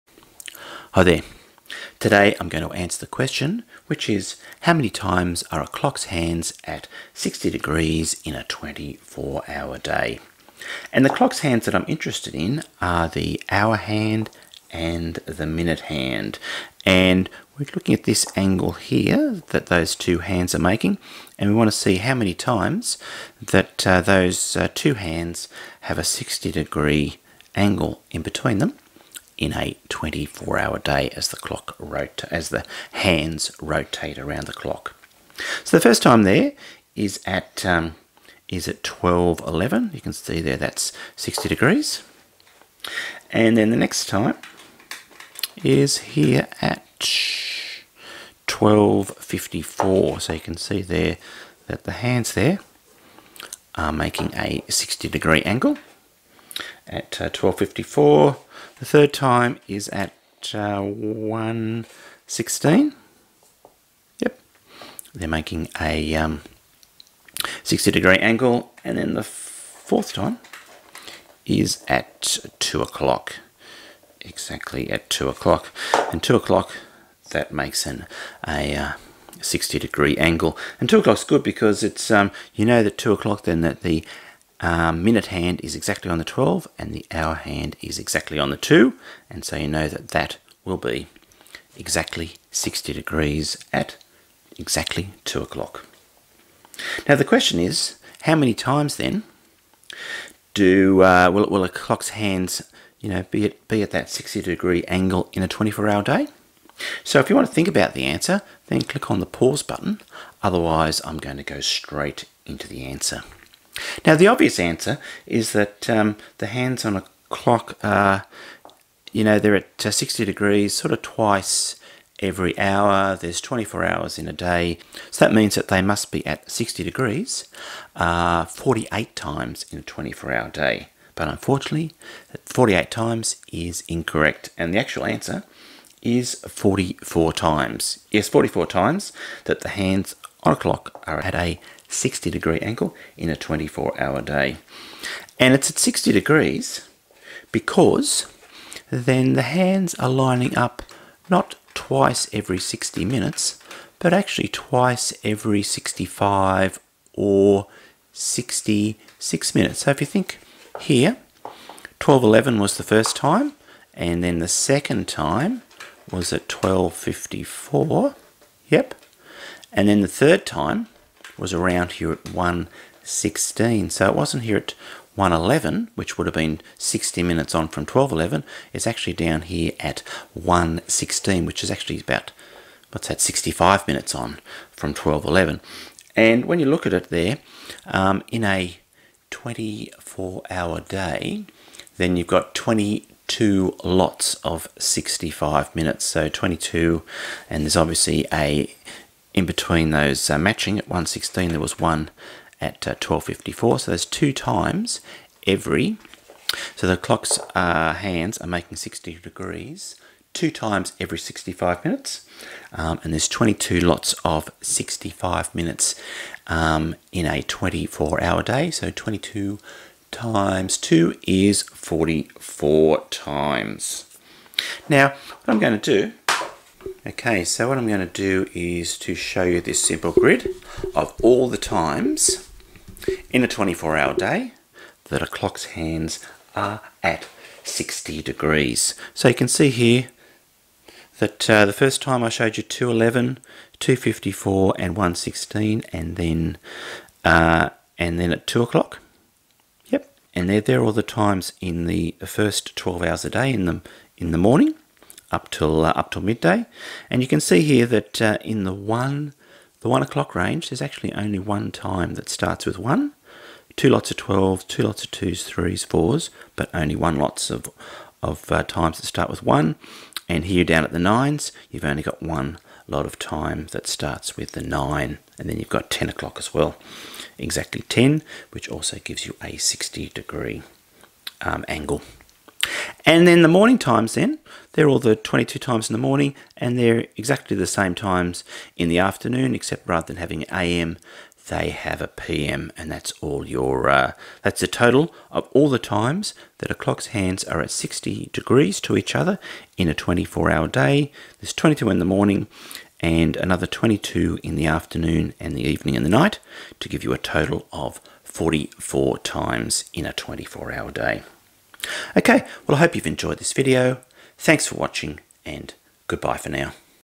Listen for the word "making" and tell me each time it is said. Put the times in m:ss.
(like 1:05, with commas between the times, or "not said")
0:20, 0:53, 1:05, 3:28.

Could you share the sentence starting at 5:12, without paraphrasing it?
Okay, well I hope you've enjoyed this video.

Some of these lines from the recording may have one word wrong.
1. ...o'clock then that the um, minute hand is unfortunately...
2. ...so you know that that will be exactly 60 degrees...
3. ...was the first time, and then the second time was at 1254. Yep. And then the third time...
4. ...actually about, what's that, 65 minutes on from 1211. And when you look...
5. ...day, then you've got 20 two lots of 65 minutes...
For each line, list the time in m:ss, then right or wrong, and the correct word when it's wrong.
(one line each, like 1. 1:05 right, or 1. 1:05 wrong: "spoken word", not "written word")
1. 1:23 wrong: "exactly", not "unfortunately"
2. 1:29 right
3. 2:42 right
4. 3:01 right
5. 3:10 right.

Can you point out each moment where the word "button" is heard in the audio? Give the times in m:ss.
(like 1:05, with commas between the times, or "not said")
1:49.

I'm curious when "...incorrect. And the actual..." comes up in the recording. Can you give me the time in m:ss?
2:13.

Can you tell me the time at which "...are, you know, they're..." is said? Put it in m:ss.
1:57.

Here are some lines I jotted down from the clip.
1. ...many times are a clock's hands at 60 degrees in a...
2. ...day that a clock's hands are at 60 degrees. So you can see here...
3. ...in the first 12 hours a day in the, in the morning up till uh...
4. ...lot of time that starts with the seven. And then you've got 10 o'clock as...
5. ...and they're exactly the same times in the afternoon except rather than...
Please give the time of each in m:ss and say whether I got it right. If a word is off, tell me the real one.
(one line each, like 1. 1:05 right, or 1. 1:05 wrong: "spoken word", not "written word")
1. 0:04 right
2. 3:54 right
3. 4:11 right
4. 4:32 wrong: "nine", not "seven"
5. 4:46 right.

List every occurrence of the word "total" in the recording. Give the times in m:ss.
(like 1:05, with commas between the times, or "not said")
4:54, 5:07.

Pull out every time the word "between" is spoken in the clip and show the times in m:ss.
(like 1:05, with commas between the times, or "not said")
0:28, 3:19.